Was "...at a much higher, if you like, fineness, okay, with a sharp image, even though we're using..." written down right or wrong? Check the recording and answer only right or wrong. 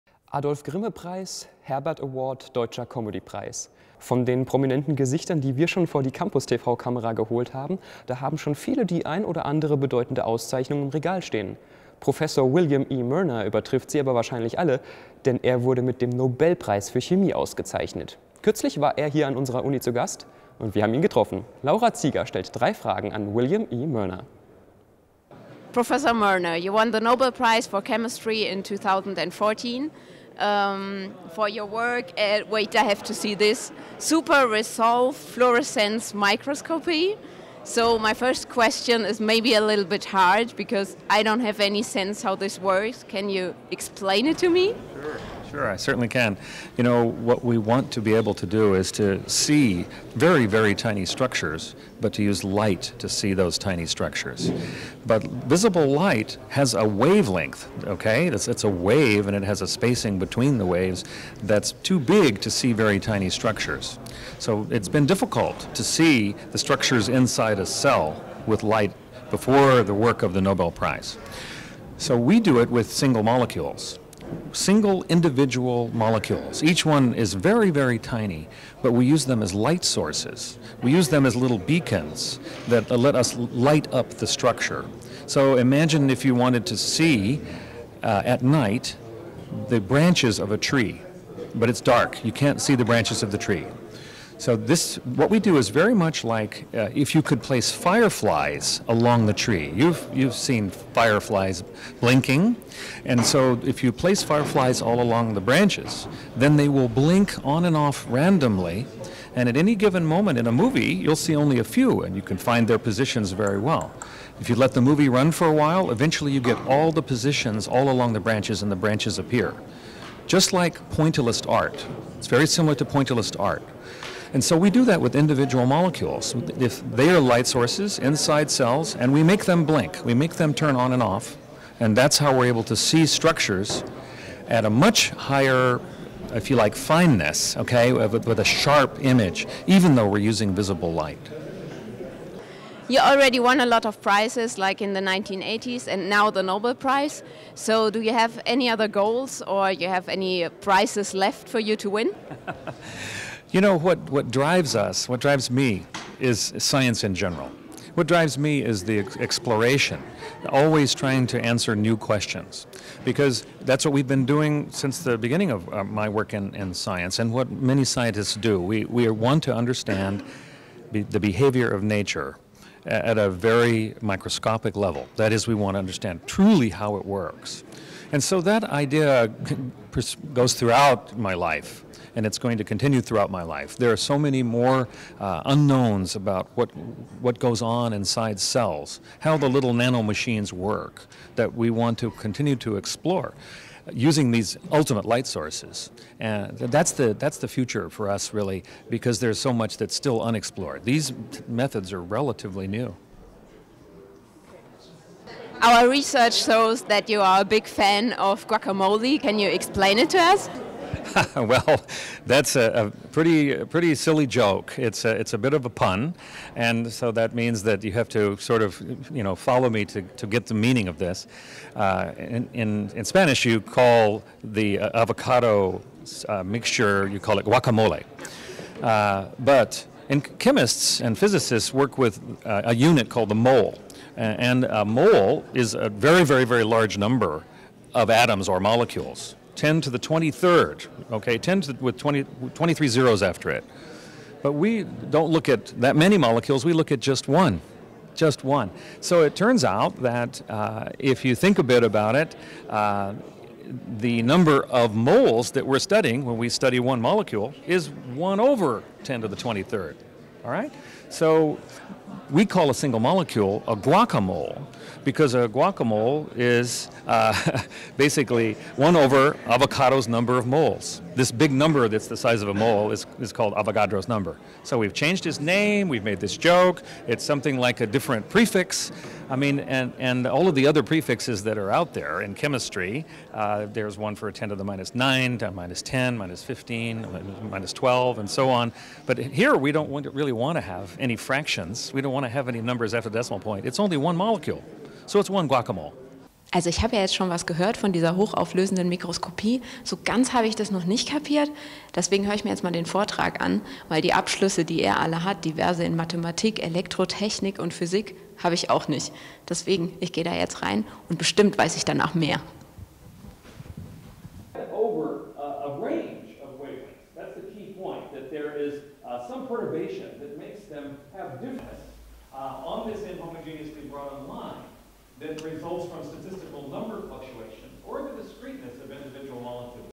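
right.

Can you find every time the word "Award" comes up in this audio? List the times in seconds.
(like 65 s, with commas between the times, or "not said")
2 s.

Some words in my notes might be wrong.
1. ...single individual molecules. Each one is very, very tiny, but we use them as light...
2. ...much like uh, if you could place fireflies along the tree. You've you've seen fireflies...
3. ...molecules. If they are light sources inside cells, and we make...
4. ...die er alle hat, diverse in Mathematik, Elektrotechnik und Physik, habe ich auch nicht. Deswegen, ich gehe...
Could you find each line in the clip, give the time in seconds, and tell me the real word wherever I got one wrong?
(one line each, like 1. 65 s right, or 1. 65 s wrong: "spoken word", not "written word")
1. 74 s right
2. 95 s right
3. 125 s right
4. 304 s right.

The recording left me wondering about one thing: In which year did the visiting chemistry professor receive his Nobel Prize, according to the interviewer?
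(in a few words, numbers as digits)
2014.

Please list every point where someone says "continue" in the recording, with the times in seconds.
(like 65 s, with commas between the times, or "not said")
182 s, 192 s.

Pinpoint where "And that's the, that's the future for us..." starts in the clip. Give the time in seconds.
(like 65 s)
196 s.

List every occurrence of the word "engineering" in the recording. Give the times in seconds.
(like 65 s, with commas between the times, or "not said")
not said.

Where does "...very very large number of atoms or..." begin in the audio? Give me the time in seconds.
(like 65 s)
236 s.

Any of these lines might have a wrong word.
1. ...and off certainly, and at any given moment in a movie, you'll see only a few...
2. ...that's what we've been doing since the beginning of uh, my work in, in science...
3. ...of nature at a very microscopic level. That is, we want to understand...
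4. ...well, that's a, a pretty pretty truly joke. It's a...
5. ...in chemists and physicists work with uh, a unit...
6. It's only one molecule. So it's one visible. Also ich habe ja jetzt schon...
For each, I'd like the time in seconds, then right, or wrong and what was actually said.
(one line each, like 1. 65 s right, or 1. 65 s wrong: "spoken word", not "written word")
1. 107 s wrong: "randomly", not "certainly"
2. 163 s right
3. 171 s right
4. 211 s wrong: "silly", not "truly"
5. 230 s right
6. 293 s wrong: "guacamole", not "visible".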